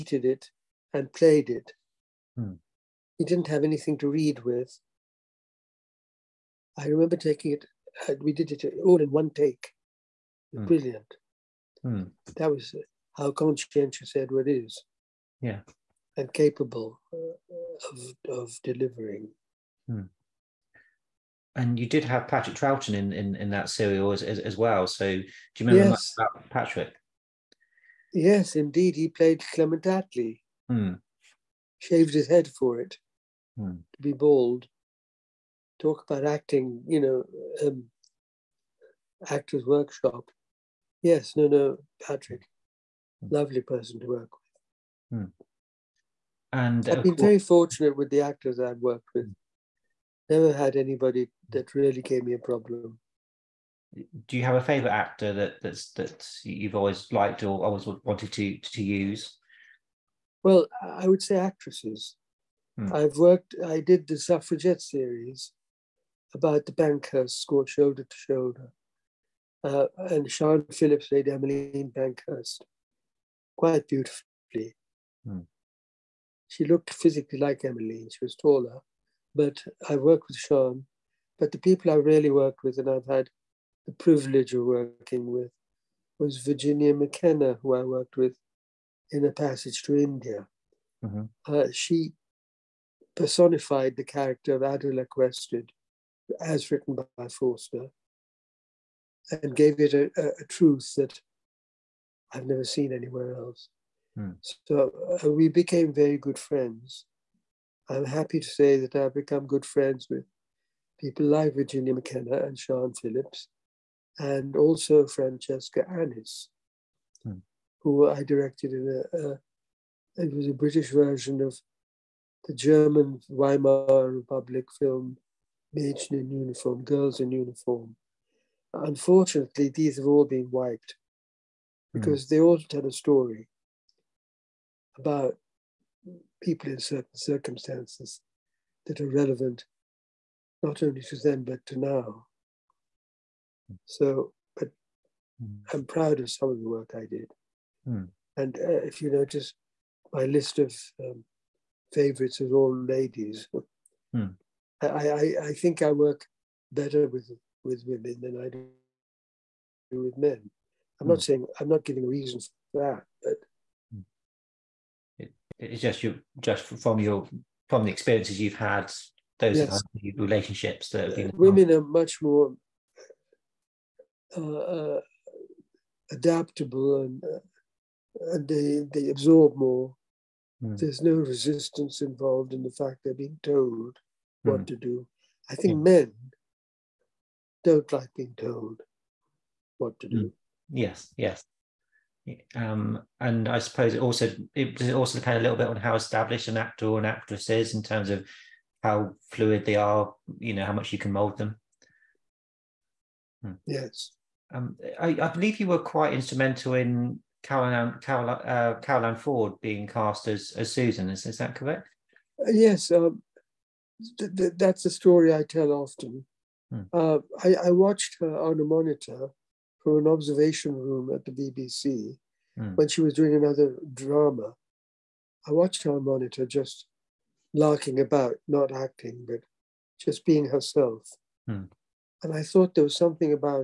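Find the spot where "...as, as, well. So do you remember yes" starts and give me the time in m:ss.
0:24.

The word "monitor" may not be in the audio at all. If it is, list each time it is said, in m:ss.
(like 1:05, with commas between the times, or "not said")
3:38, 3:45.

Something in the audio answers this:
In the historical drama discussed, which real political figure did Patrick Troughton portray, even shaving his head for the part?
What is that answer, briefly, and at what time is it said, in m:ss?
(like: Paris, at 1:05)
Clement Attlee, at 0:29.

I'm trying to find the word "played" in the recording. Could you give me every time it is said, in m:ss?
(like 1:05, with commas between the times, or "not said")
0:01, 0:29, 1:11.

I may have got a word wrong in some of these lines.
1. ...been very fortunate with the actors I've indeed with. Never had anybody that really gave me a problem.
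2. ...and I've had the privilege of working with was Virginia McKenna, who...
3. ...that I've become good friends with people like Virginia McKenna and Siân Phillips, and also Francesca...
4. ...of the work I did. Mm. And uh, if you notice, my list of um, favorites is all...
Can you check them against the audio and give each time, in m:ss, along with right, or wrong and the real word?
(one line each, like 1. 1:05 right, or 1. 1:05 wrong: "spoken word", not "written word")
1. 0:47 wrong: "worked", not "indeed"
2. 1:22 right
3. 1:48 right
4. 2:26 right.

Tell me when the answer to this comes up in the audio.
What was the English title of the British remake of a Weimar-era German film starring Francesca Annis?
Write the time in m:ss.
2:06.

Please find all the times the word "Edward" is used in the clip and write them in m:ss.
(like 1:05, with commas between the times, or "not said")
0:14.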